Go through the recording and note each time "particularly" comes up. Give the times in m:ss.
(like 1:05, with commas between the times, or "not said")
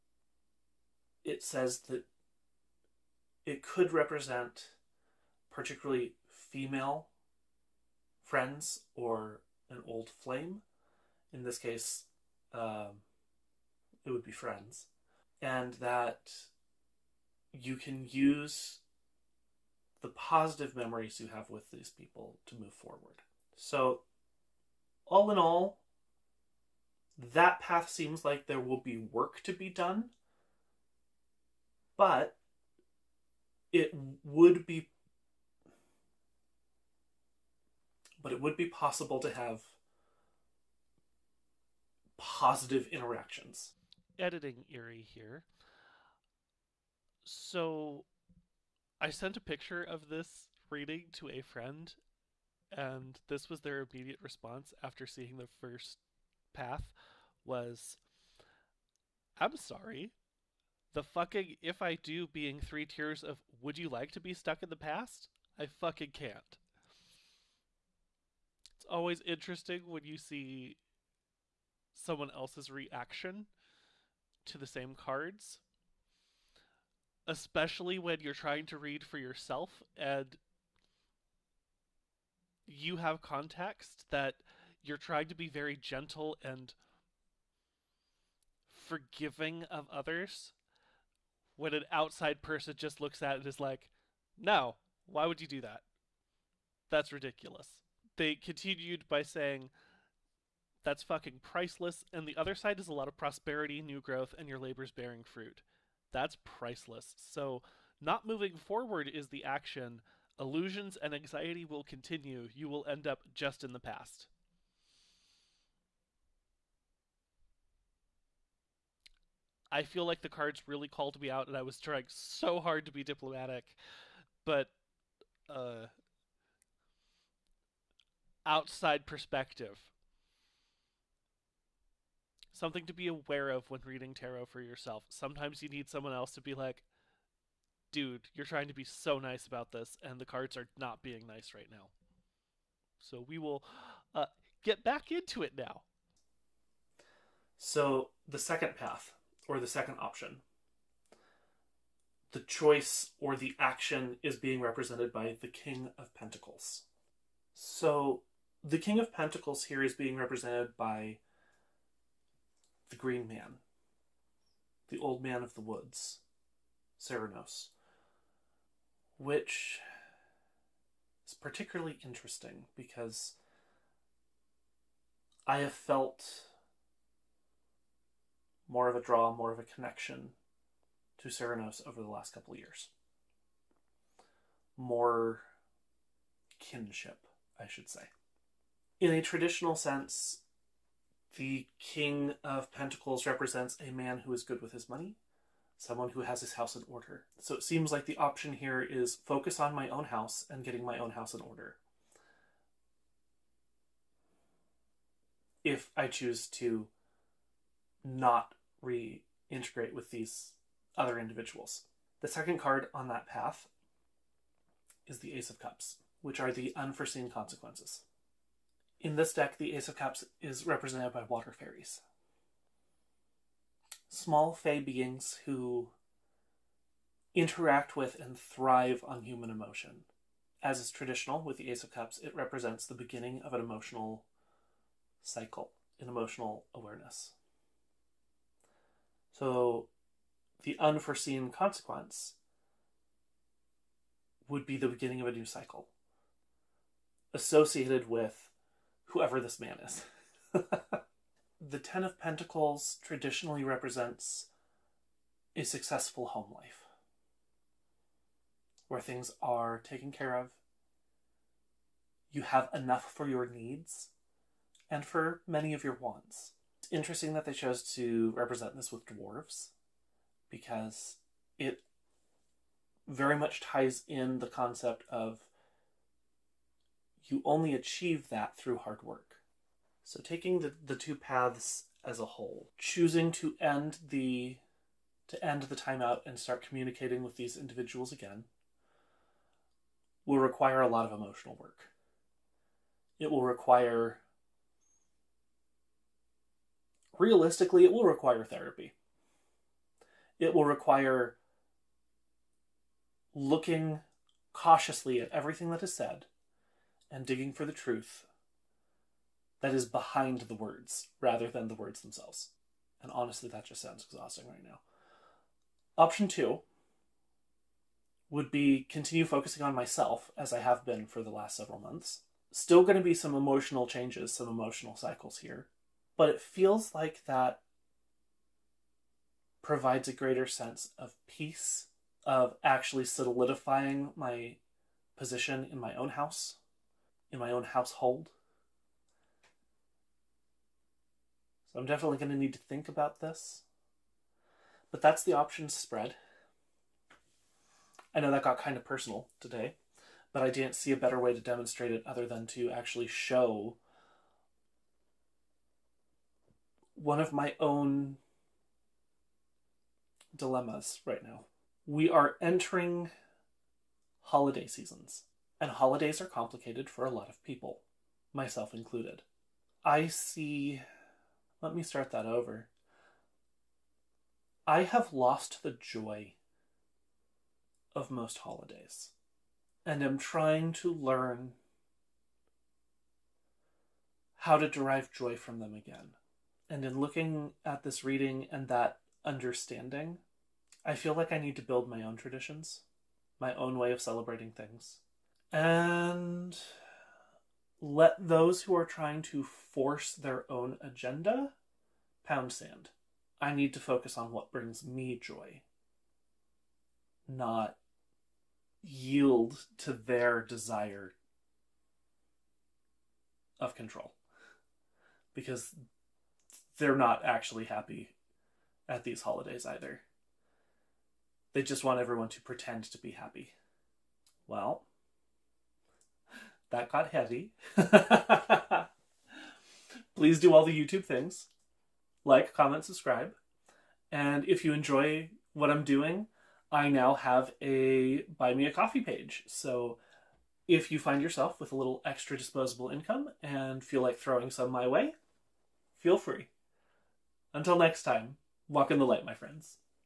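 0:05, 2:51.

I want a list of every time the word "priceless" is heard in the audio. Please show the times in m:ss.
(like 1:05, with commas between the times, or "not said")
1:41, 1:46.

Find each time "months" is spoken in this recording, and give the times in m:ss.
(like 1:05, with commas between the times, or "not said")
5:21.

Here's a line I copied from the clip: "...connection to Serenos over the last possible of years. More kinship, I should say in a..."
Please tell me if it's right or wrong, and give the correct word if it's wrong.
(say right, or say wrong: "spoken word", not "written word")
wrong: "couple", not "possible".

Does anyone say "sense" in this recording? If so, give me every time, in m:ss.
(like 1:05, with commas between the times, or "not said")
3:09, 5:30.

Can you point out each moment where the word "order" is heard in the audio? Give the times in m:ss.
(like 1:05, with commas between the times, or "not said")
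3:16, 3:21.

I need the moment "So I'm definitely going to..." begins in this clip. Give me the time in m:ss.
5:41.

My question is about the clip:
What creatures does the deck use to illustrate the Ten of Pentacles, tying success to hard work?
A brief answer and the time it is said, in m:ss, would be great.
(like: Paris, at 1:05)
Dwarves, at 4:29.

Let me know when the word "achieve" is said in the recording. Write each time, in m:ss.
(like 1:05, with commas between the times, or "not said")
4:37.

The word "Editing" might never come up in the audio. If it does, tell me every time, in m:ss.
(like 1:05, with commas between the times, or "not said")
0:44.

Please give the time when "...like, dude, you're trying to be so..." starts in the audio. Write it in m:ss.
2:16.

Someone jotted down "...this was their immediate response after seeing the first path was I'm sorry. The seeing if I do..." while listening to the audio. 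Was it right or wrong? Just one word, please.
wrong.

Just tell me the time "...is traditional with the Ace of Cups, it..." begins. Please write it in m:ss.
3:50.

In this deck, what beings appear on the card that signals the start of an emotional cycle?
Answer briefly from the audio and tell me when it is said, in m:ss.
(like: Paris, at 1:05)
Water fairies, at 3:41.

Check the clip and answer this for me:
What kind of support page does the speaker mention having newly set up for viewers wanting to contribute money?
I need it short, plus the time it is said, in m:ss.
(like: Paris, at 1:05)
Buy me a coffee, at 7:18.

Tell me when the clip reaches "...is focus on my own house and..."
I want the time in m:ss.
3:18.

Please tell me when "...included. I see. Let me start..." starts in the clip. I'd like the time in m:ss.
6:08.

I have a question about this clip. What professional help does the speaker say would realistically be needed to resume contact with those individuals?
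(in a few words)
Therapy.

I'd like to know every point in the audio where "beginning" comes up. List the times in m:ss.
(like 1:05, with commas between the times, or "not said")
3:52, 4:04.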